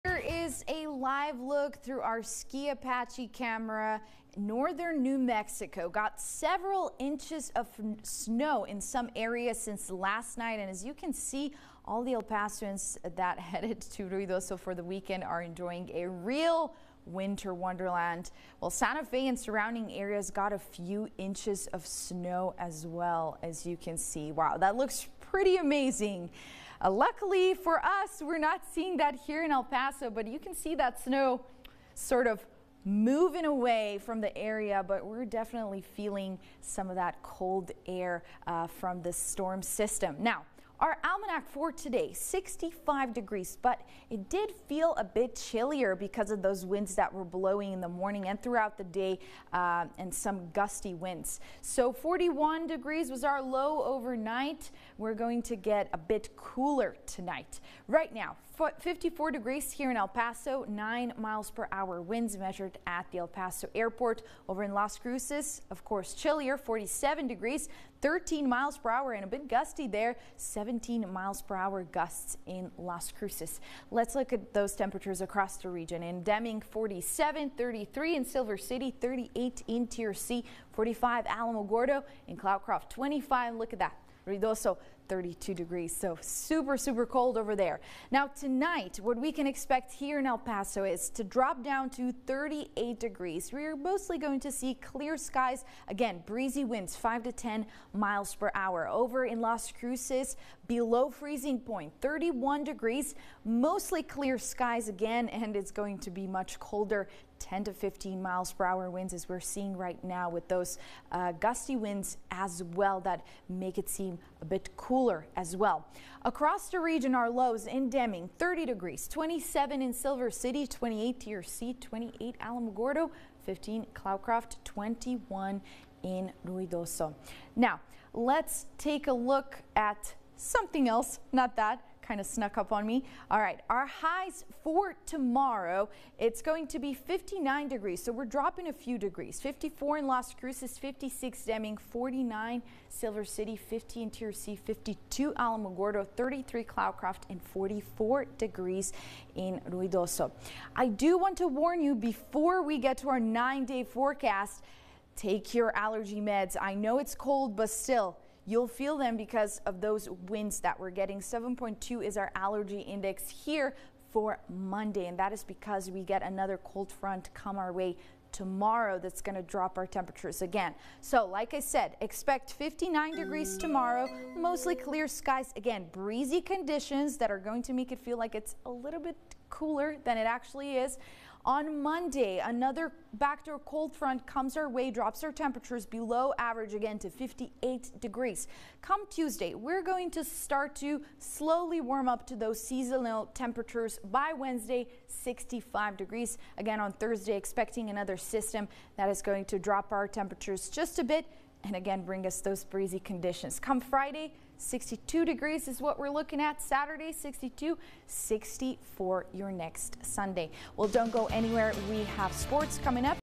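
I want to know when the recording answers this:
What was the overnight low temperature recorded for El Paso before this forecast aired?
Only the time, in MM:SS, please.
00:51.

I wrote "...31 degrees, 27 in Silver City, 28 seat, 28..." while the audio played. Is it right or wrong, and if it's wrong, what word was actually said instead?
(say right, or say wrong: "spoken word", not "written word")
wrong: "30", not "31".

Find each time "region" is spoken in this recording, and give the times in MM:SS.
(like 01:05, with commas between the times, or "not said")
01:15, 01:56.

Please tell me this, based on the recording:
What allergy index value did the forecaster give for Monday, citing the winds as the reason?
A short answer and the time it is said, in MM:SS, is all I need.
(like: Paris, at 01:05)
7.2, at 02:41.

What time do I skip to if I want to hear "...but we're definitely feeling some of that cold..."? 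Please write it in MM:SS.
00:34.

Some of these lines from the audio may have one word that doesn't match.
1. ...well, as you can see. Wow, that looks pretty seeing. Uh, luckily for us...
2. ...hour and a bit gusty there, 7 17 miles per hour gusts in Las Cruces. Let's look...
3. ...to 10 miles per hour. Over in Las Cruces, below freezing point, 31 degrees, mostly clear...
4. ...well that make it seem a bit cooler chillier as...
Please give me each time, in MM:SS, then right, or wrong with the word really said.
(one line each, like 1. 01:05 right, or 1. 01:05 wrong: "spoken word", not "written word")
1. 00:22 wrong: "amazing", not "seeing"
2. 01:08 right
3. 01:37 right
4. 01:52 wrong: "cooler", not "chillier".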